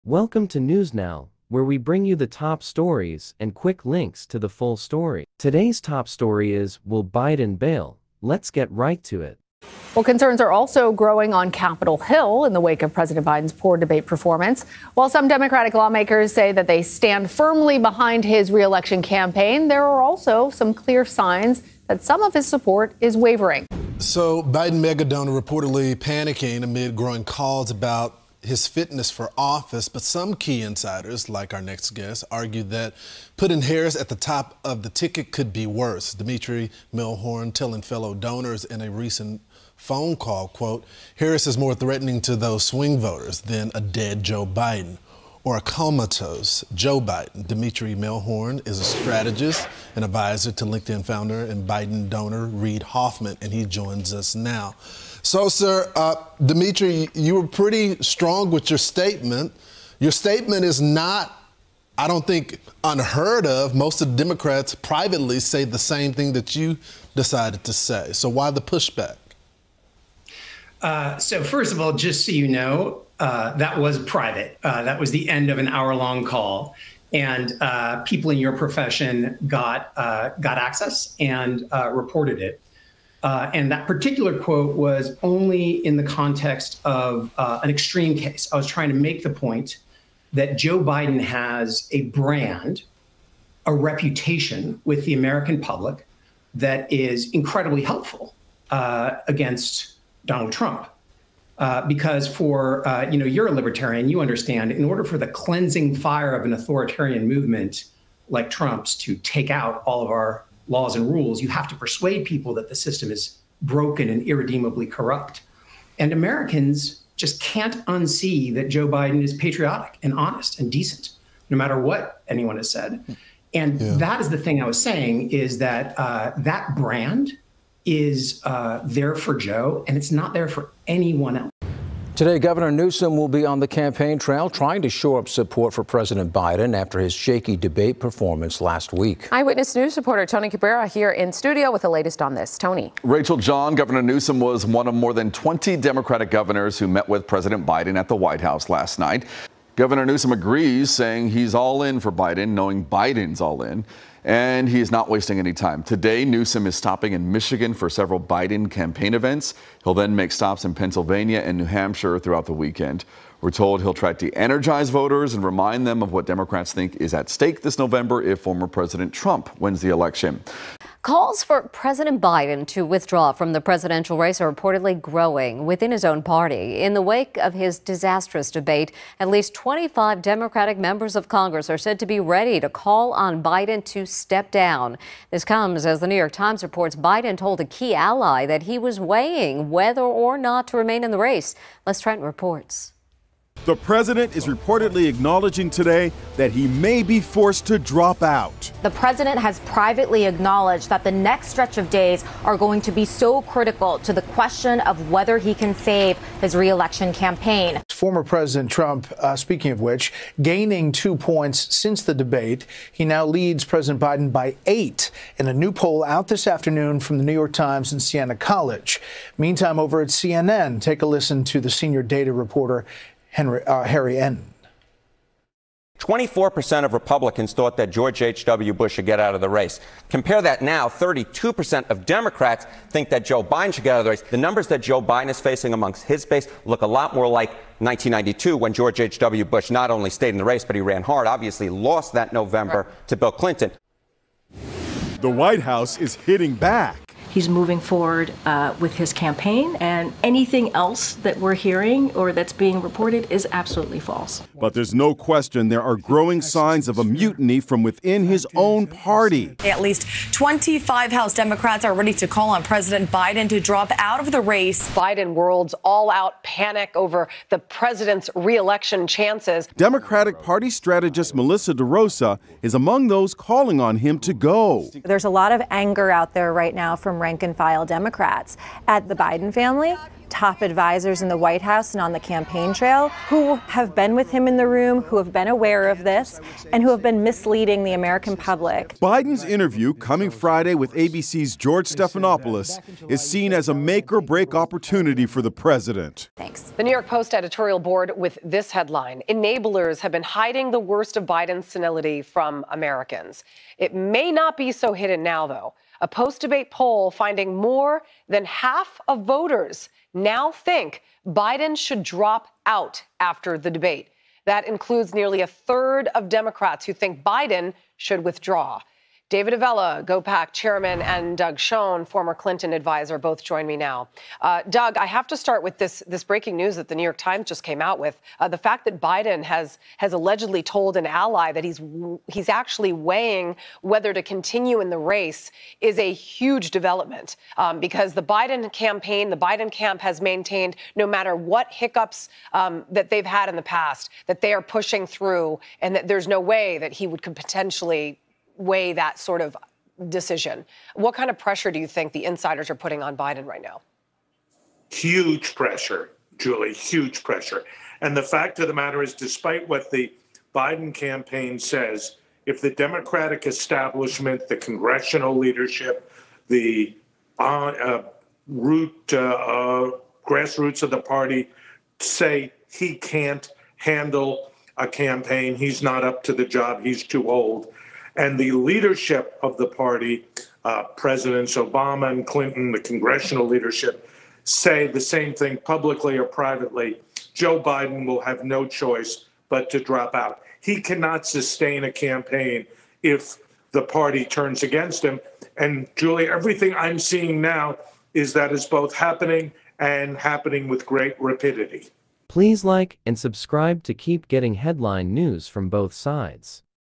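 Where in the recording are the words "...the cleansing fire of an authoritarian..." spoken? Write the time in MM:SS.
01:45.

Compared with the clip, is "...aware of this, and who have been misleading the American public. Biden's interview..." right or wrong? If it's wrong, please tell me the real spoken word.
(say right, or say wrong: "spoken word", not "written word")
right.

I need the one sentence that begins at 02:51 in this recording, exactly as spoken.
Calls for President Biden to withdraw from the presidential race are reportedly growing within his own party.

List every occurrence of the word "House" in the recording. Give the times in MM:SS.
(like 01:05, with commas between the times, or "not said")
02:28, 04:05, 04:21, 04:41.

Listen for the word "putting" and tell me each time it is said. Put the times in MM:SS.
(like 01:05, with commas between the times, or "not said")
00:33, 05:52.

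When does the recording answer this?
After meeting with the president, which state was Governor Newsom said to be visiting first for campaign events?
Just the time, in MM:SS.
02:37.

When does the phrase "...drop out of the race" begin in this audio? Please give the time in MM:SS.
04:23.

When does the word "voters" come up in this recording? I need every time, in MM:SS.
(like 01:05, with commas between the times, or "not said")
00:42, 02:44, 05:09.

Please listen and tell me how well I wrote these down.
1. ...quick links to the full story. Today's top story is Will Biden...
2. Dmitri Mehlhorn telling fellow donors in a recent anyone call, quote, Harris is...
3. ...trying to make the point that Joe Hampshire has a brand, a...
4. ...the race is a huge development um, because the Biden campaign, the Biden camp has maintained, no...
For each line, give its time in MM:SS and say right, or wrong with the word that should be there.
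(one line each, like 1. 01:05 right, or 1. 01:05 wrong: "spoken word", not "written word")
1. 00:03 right
2. 00:36 wrong: "phone", not "anyone"
3. 01:28 wrong: "Biden", not "Hampshire"
4. 05:34 right.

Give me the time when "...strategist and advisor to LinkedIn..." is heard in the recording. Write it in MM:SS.
00:48.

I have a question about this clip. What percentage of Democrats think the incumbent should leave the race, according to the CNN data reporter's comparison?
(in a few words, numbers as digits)
32%.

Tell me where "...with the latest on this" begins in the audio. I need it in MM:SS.
02:21.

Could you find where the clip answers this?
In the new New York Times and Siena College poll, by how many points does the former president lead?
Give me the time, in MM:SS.
03:34.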